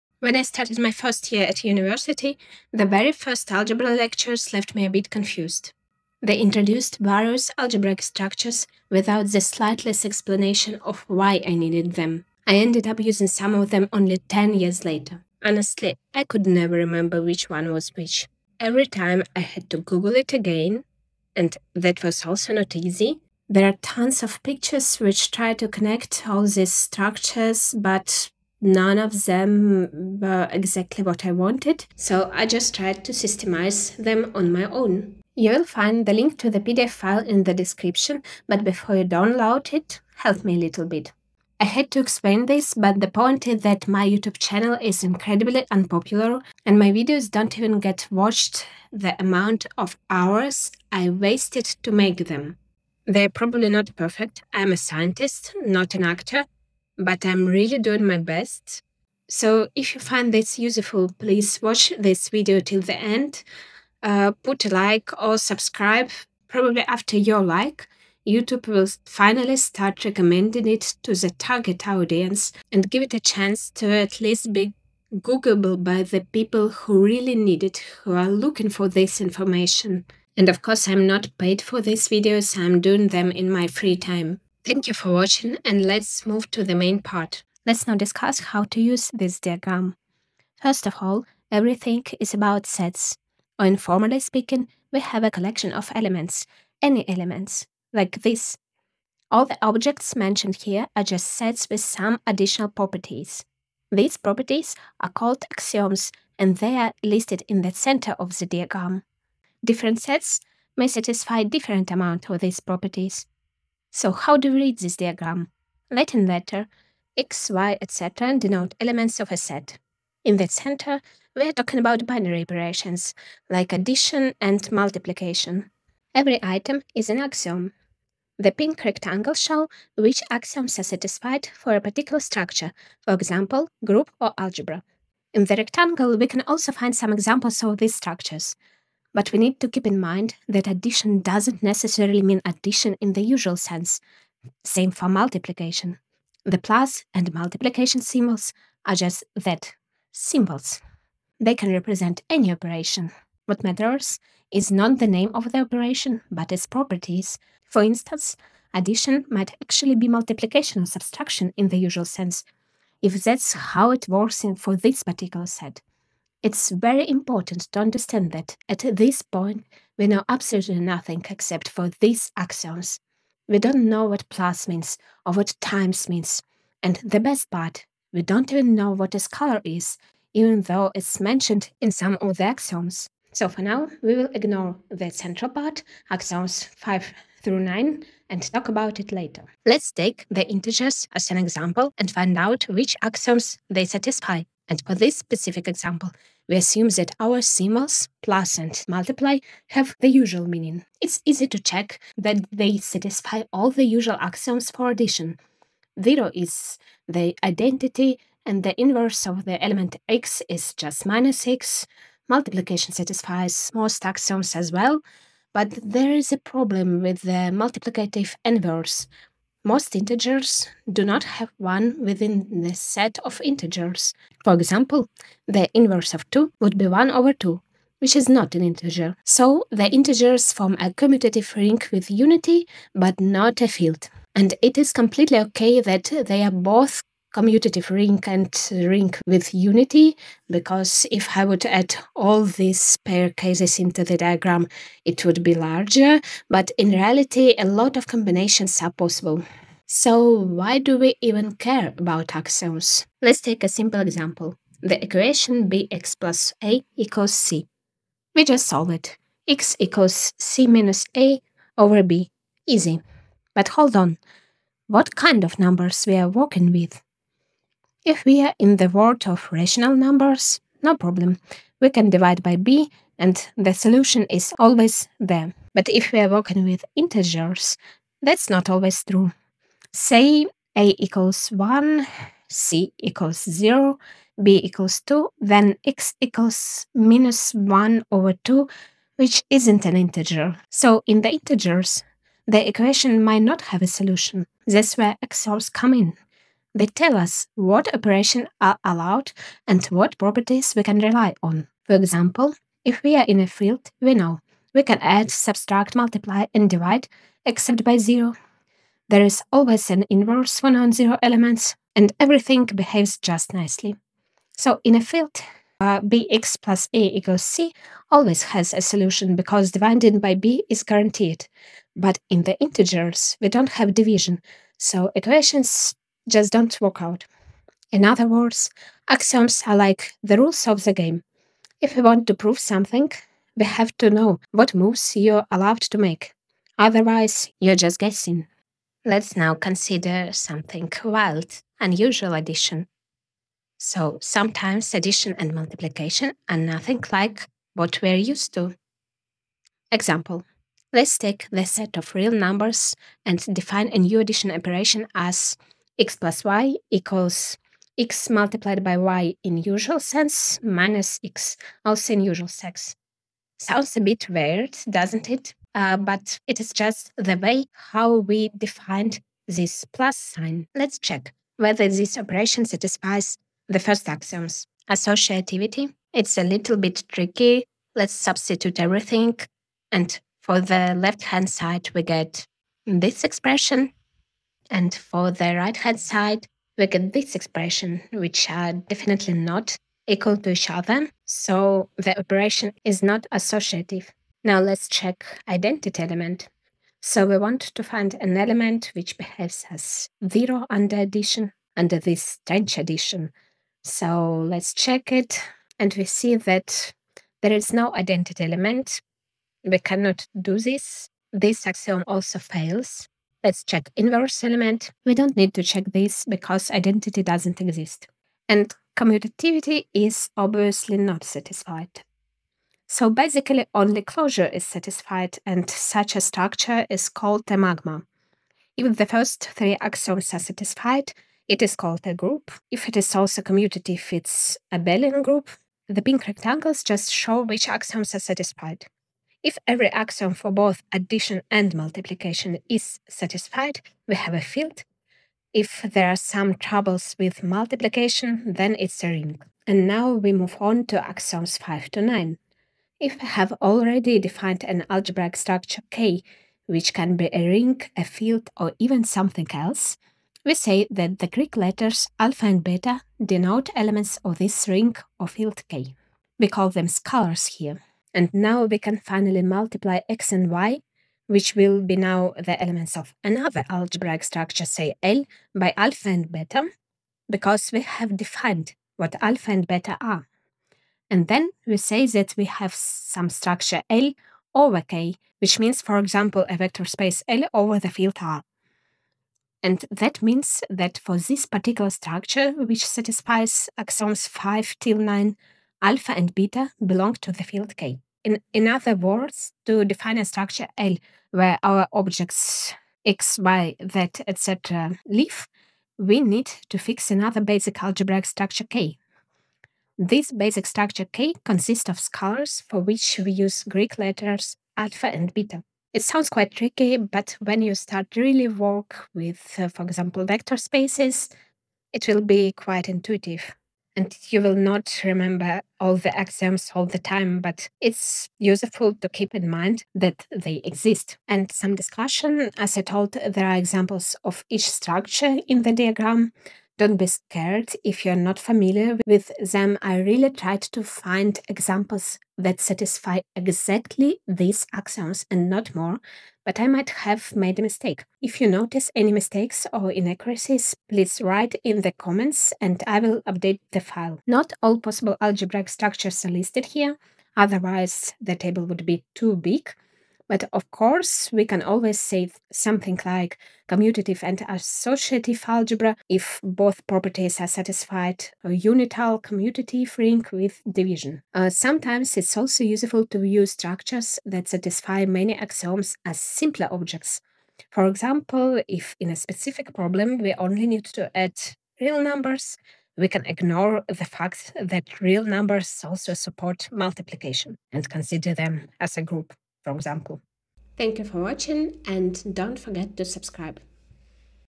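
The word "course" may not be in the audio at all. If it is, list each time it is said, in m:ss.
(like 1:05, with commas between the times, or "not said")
1:20, 9:20.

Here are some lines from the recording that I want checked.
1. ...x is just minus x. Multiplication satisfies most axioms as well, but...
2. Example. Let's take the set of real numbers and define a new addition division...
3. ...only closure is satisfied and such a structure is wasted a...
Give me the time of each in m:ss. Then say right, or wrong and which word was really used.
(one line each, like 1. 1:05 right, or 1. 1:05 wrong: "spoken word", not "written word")
1. 3:30 right
2. 5:49 wrong: "operation", not "division"
3. 7:03 wrong: "called", not "wasted".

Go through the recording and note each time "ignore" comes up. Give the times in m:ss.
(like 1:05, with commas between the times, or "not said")
3:04, 9:43.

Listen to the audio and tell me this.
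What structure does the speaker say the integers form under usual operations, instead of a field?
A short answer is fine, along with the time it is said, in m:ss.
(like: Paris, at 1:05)
Commutative ring with unity, at 3:50.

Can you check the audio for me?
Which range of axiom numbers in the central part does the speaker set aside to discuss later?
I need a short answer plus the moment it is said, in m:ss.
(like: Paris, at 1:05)
5 through 9, at 3:06.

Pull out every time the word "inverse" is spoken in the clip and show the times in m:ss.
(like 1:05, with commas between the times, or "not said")
3:28, 3:38, 3:45, 5:10, 6:53.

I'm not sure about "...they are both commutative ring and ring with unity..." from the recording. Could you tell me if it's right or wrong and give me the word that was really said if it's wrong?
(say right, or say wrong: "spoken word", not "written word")
right.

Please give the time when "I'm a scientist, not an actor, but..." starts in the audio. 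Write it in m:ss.
0:54.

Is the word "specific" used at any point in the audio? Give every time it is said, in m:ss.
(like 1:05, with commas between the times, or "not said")
3:15, 9:39.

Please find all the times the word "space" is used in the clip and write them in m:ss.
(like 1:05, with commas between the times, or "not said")
8:06, 8:40.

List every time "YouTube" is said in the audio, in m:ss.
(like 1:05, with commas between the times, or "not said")
0:44, 1:08.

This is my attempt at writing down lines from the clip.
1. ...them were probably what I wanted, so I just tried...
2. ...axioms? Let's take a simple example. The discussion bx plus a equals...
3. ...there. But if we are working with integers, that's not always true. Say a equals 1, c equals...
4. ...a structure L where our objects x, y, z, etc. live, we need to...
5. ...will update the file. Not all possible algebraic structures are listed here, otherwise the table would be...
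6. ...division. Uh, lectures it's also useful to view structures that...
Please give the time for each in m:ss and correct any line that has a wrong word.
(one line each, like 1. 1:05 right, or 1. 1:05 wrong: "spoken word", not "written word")
1. 0:29 wrong: "exactly", not "probably"
2. 4:12 wrong: "equation", not "discussion"
3. 4:35 right
4. 8:20 right
5. 9:12 right
6. 9:30 wrong: "sometimes", not "lectures".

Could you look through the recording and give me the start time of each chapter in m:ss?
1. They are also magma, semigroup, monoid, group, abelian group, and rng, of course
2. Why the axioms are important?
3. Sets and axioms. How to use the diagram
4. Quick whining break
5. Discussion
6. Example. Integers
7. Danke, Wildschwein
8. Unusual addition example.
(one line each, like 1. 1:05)
1. 3:50
2. 4:09
3. 1:26
4. 0:41
5. 8:50
6. 3:08
7. 9:36
8. 5:38.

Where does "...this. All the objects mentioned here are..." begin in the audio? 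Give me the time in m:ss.
1:38.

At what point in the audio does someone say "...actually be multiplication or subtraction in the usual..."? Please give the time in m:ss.
2:39.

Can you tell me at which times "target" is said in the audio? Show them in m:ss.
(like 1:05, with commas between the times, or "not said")
1:11.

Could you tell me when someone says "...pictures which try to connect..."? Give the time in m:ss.
0:24.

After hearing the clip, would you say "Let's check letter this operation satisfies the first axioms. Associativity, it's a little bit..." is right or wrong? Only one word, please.
wrong.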